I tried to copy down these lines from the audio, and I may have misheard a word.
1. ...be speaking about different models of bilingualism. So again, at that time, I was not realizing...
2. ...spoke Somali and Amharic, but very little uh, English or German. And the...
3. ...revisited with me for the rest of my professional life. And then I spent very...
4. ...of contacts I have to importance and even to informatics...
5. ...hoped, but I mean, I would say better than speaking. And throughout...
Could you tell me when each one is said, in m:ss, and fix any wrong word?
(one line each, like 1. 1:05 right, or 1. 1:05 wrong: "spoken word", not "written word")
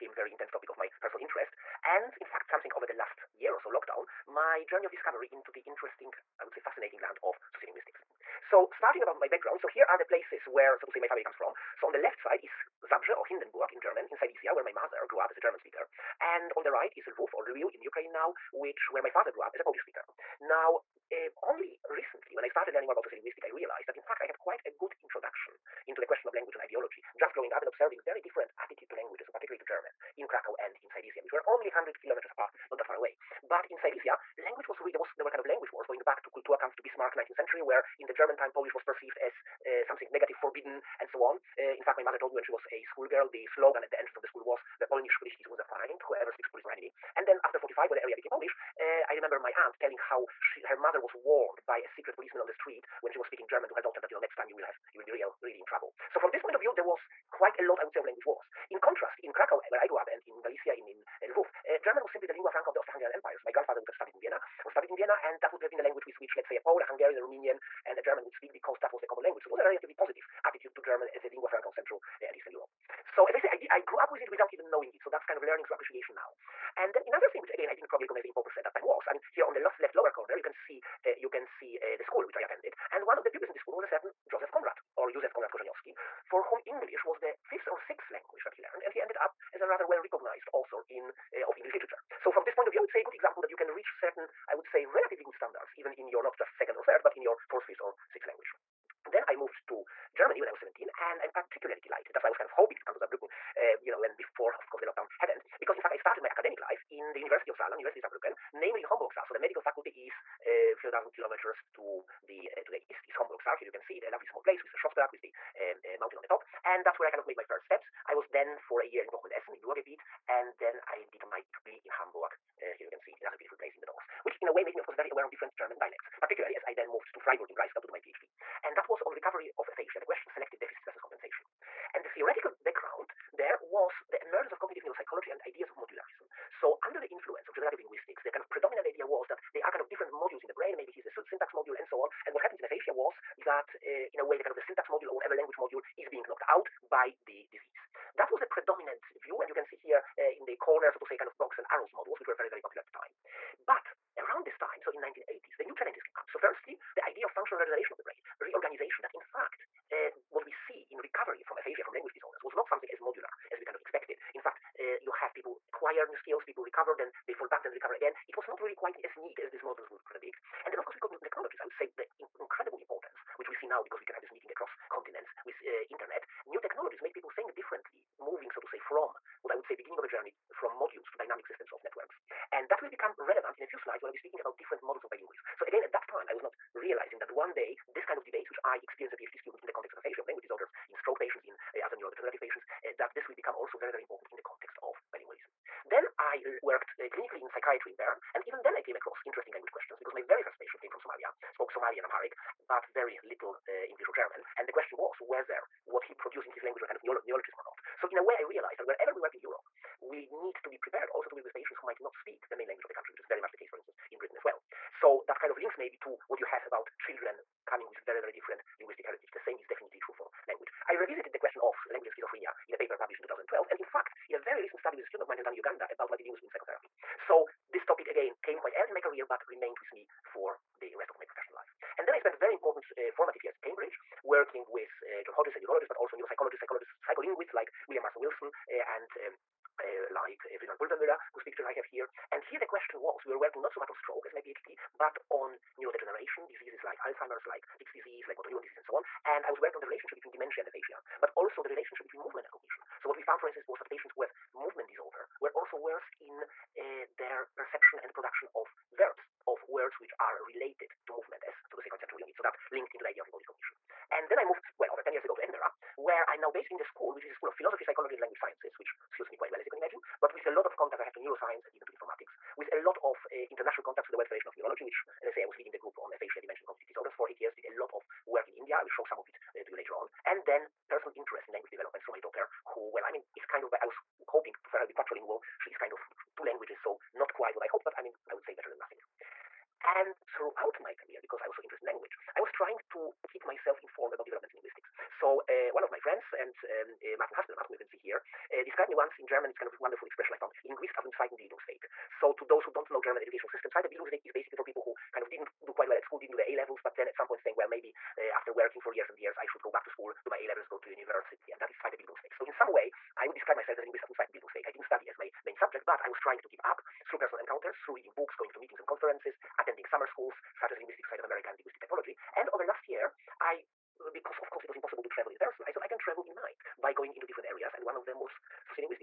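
1. 3:04 right
2. 3:21 right
3. 3:49 wrong: "remained", not "revisited"
4. 4:30 wrong: "neuroscience", not "importance"
5. 4:47 wrong: "nothing", not "speaking".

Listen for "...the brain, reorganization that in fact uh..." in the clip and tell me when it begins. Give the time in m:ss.
2:37.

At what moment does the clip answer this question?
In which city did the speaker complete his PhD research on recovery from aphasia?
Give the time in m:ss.
2:07.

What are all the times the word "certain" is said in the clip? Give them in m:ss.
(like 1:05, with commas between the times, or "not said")
1:23, 1:34.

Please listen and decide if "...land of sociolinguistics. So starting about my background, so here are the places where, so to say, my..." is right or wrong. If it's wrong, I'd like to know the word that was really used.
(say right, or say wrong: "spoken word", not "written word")
right.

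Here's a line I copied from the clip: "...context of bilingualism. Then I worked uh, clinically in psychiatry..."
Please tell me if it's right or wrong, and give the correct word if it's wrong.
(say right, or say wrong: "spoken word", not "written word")
right.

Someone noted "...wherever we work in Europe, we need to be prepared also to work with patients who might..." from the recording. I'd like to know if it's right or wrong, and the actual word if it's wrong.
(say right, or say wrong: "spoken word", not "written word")
right.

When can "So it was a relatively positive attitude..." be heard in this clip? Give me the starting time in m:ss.
1:09.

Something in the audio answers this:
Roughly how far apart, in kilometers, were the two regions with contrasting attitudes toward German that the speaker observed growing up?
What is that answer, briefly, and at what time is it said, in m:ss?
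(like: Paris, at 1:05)
100 kilometers, at 0:31.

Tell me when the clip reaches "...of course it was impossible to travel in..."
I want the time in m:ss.
5:24.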